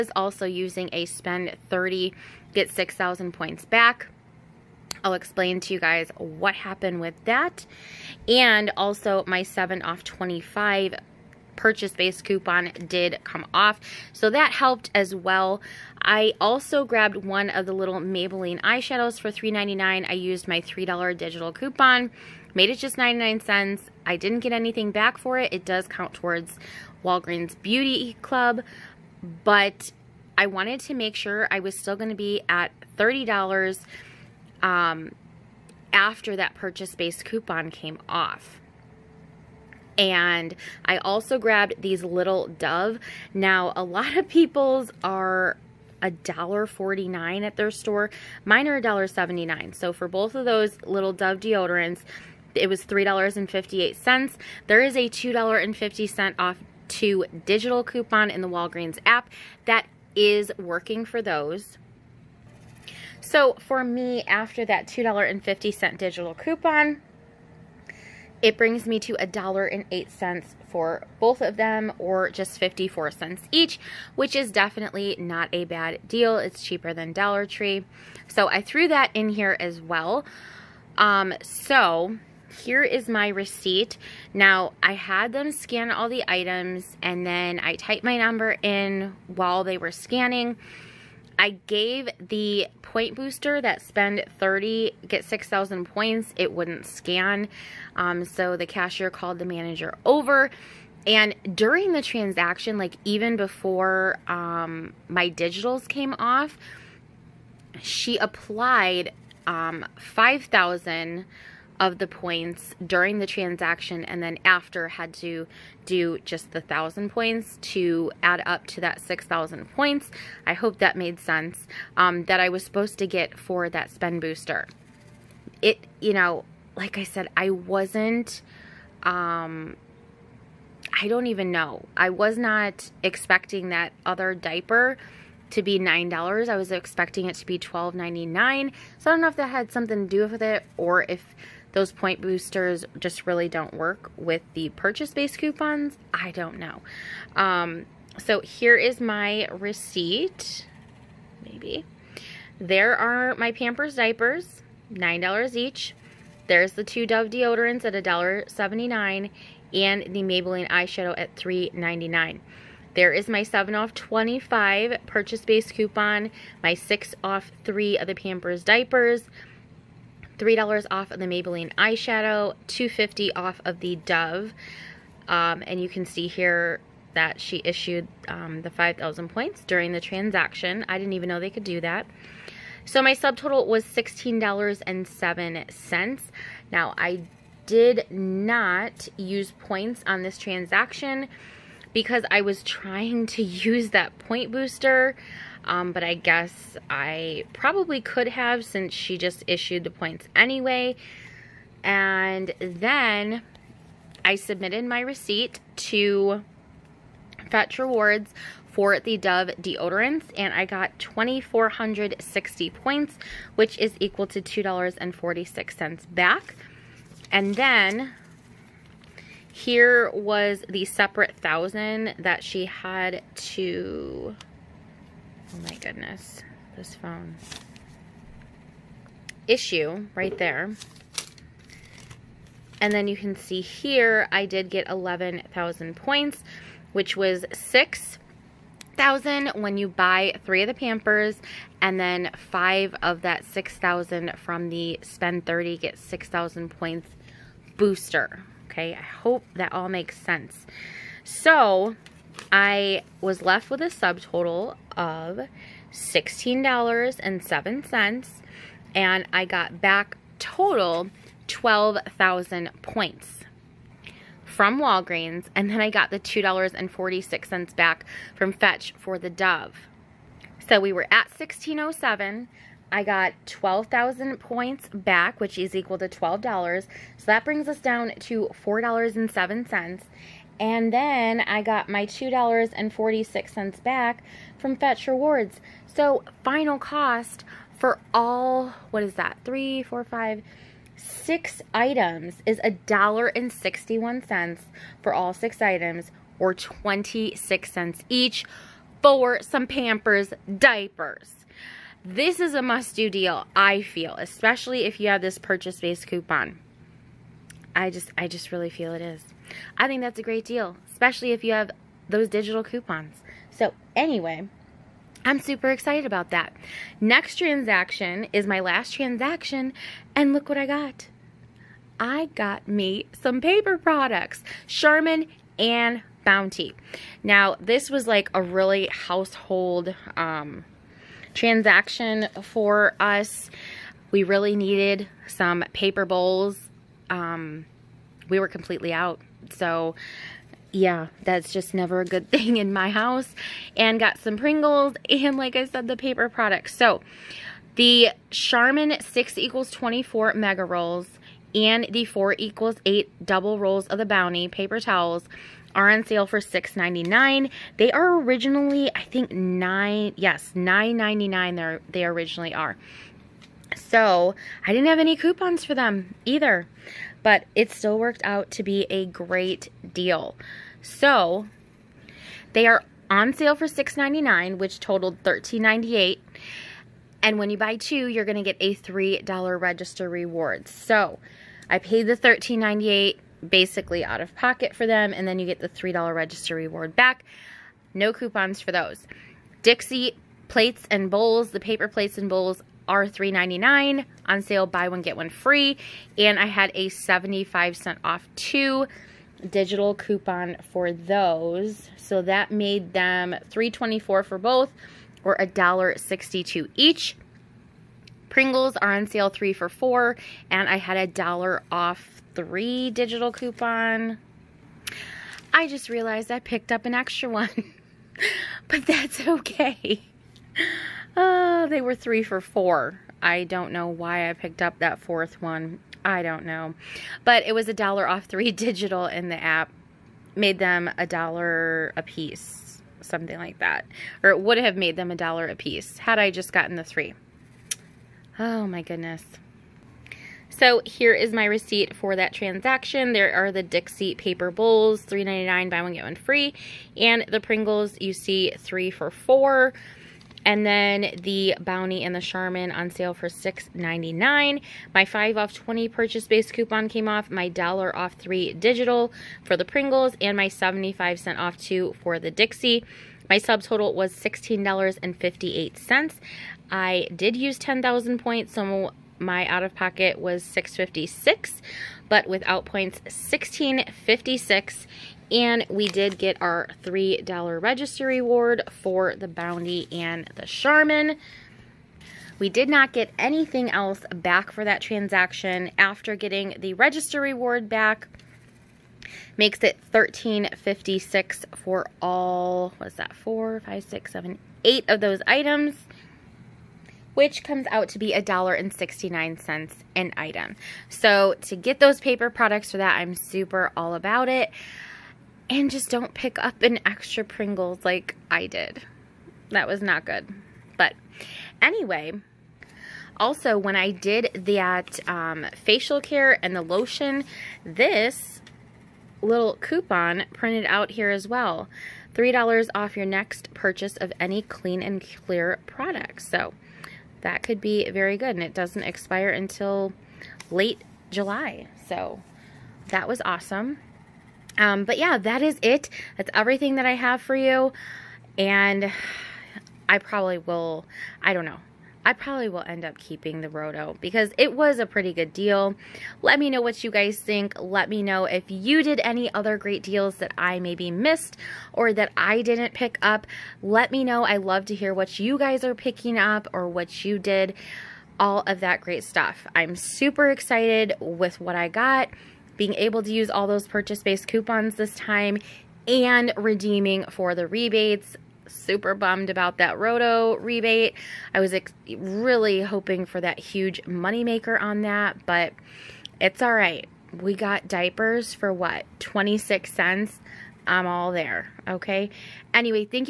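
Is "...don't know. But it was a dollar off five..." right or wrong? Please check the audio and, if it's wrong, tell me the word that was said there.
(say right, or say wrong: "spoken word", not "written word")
wrong: "three", not "five".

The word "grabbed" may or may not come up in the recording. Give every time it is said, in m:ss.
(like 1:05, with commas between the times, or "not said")
0:16, 0:41.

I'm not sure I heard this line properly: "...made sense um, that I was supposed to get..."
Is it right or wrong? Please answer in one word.
right.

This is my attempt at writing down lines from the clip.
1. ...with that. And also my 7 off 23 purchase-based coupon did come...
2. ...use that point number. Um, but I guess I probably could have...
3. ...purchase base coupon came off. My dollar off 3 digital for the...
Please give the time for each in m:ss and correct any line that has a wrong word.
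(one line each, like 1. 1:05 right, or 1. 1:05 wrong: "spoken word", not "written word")
1. 0:06 wrong: "25", not "23"
2. 3:13 wrong: "booster", not "number"
3. 7:35 right.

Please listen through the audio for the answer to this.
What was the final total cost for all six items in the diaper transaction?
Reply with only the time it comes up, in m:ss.
4:52.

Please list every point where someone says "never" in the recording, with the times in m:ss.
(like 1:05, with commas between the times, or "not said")
5:41.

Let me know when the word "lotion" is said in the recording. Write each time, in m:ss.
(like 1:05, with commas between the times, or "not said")
8:36.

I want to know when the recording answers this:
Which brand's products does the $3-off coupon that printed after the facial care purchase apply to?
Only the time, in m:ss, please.
8:44.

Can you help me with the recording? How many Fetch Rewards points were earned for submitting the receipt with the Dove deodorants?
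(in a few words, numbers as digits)
2,460.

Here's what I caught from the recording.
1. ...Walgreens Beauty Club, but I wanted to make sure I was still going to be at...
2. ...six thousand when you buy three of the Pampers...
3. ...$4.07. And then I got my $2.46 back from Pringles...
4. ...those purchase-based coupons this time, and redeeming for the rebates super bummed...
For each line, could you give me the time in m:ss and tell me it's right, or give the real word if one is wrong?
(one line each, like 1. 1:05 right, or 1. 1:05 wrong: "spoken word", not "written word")
1. 0:27 right
2. 3:57 right
3. 4:38 wrong: "Fetch", not "Pringles"
4. 9:23 right.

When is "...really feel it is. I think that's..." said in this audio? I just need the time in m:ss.
5:08.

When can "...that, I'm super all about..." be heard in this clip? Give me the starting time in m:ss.
8:22.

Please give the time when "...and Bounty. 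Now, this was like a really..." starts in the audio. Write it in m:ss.
5:25.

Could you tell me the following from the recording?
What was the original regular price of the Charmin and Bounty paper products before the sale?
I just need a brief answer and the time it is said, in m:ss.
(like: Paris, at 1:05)
$9.99, at 6:00.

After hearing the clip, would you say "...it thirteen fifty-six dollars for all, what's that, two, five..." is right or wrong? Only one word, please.
wrong.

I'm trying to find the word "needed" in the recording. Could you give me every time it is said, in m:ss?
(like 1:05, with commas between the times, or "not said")
5:34.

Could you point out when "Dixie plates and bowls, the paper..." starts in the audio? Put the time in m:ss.
6:29.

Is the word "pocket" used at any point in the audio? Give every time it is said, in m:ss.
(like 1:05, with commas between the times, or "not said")
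6:24, 7:49.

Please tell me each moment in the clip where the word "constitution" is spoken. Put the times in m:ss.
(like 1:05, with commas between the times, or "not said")
not said.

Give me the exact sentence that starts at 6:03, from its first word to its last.
So I didn't have any coupons for them either, but it still worked out to be a great deal.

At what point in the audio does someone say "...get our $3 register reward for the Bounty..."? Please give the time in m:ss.
7:56.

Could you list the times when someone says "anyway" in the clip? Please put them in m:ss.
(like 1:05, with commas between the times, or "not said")
3:20, 5:13, 8:31, 9:42.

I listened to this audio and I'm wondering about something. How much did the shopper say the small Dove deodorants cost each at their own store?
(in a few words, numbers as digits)
$1.79.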